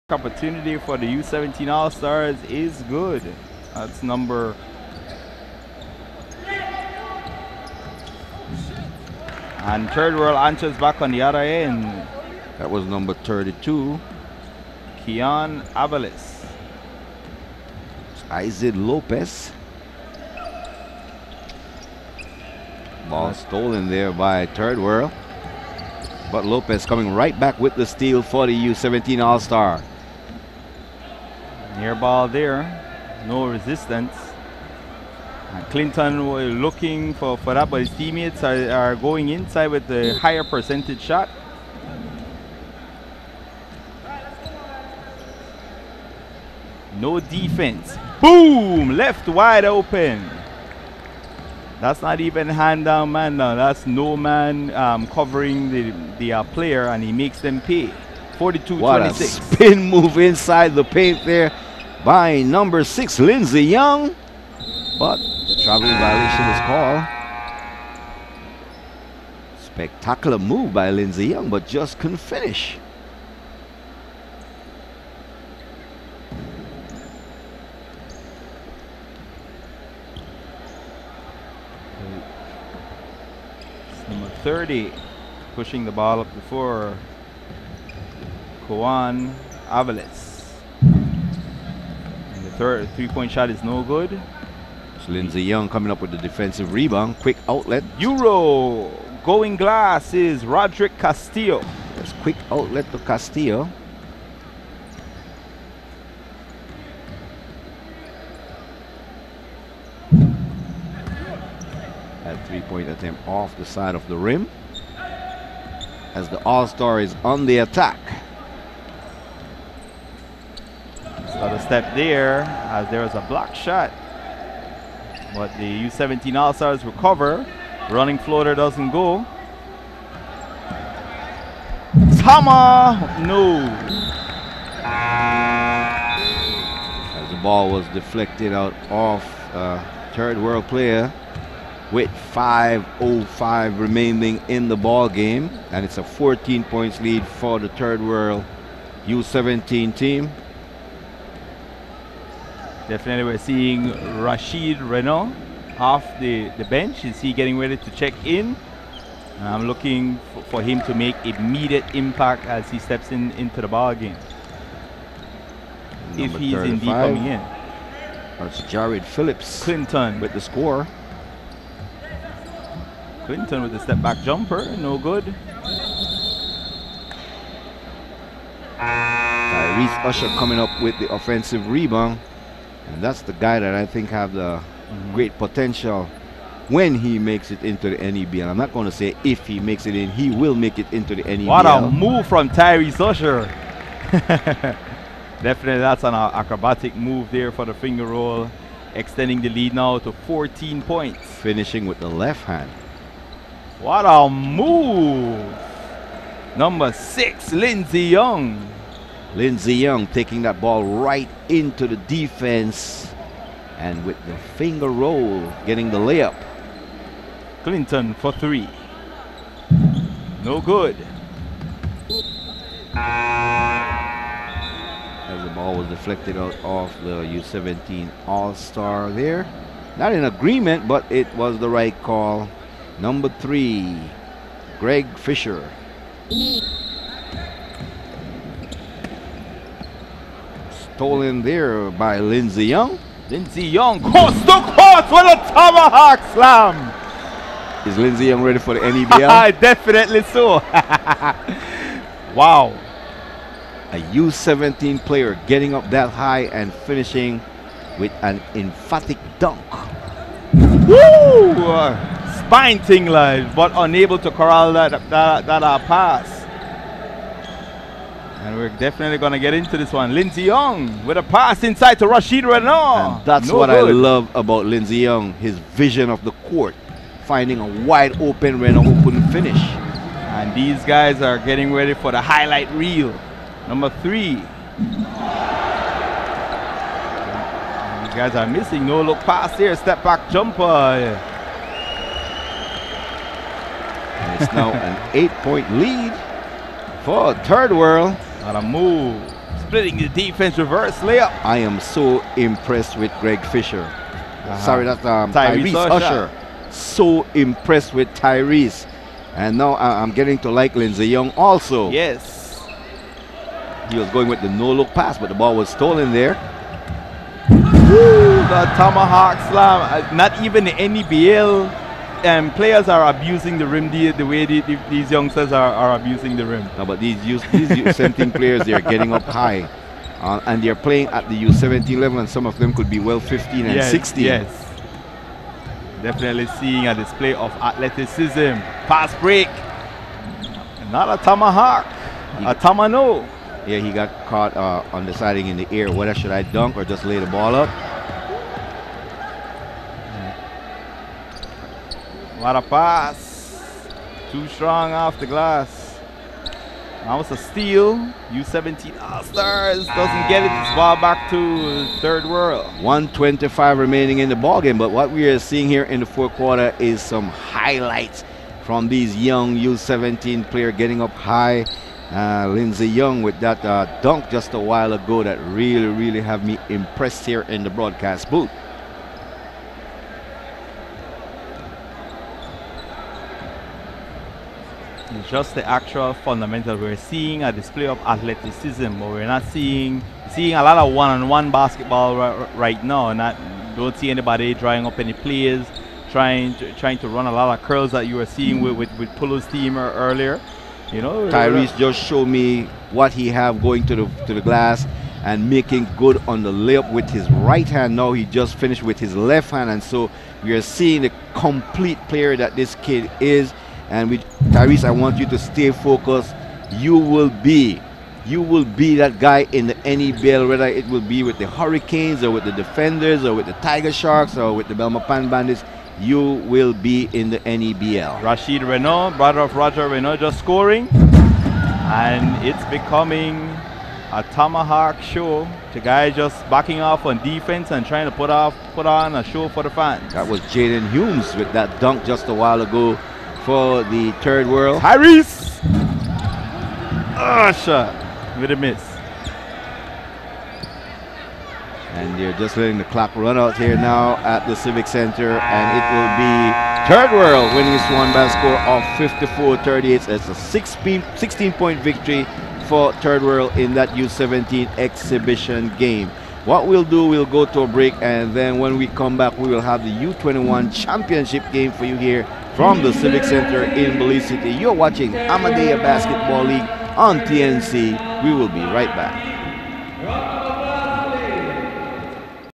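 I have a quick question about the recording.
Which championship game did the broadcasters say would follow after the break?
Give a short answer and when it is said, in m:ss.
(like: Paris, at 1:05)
U21 championship, at 7:49.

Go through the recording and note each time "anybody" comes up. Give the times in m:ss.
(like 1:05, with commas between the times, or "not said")
6:34.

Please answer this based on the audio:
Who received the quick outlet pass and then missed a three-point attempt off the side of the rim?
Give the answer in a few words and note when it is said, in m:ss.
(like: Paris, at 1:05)
Roderick Castillo, at 1:40.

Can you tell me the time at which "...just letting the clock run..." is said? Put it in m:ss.
7:32.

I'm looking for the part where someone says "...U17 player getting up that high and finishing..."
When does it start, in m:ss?
4:14.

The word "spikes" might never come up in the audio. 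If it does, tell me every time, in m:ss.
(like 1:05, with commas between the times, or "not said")
not said.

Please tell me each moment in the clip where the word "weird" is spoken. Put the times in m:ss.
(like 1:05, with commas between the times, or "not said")
not said.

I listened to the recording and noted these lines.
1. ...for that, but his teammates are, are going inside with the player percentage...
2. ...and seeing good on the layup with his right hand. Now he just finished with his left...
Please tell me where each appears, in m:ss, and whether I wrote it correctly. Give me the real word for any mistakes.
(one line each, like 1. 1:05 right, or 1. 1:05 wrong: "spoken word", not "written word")
1. 0:37 wrong: "higher", not "player"
2. 6:45 wrong: "making", not "seeing".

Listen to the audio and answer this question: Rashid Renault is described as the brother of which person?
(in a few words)
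Roger Renault.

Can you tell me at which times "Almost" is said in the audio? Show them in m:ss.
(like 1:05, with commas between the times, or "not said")
5:57.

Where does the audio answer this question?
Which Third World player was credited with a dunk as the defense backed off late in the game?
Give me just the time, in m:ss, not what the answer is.
7:20.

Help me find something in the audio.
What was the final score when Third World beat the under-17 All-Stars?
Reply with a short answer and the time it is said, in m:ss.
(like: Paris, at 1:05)
54-38, at 7:39.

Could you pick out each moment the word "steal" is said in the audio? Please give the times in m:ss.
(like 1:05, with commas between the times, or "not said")
0:27, 5:57.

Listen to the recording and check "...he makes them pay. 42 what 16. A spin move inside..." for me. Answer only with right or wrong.
wrong.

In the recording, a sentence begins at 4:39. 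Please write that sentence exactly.
And these guys are getting ready for the highlight reel.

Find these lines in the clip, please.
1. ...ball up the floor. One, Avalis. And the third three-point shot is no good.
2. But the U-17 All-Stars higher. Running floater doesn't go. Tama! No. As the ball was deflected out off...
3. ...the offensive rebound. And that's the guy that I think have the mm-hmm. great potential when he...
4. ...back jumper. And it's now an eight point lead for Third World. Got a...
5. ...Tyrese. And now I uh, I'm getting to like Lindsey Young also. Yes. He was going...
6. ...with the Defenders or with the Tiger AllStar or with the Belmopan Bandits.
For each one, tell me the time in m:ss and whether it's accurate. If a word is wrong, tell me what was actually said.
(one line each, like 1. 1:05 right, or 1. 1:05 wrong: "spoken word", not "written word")
1. 1:25 right
2. 2:05 wrong: "recover", not "higher"
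3. 3:00 right
4. 4:50 right
5. 5:08 right
6. 7:02 wrong: "Sharks", not "AllStar".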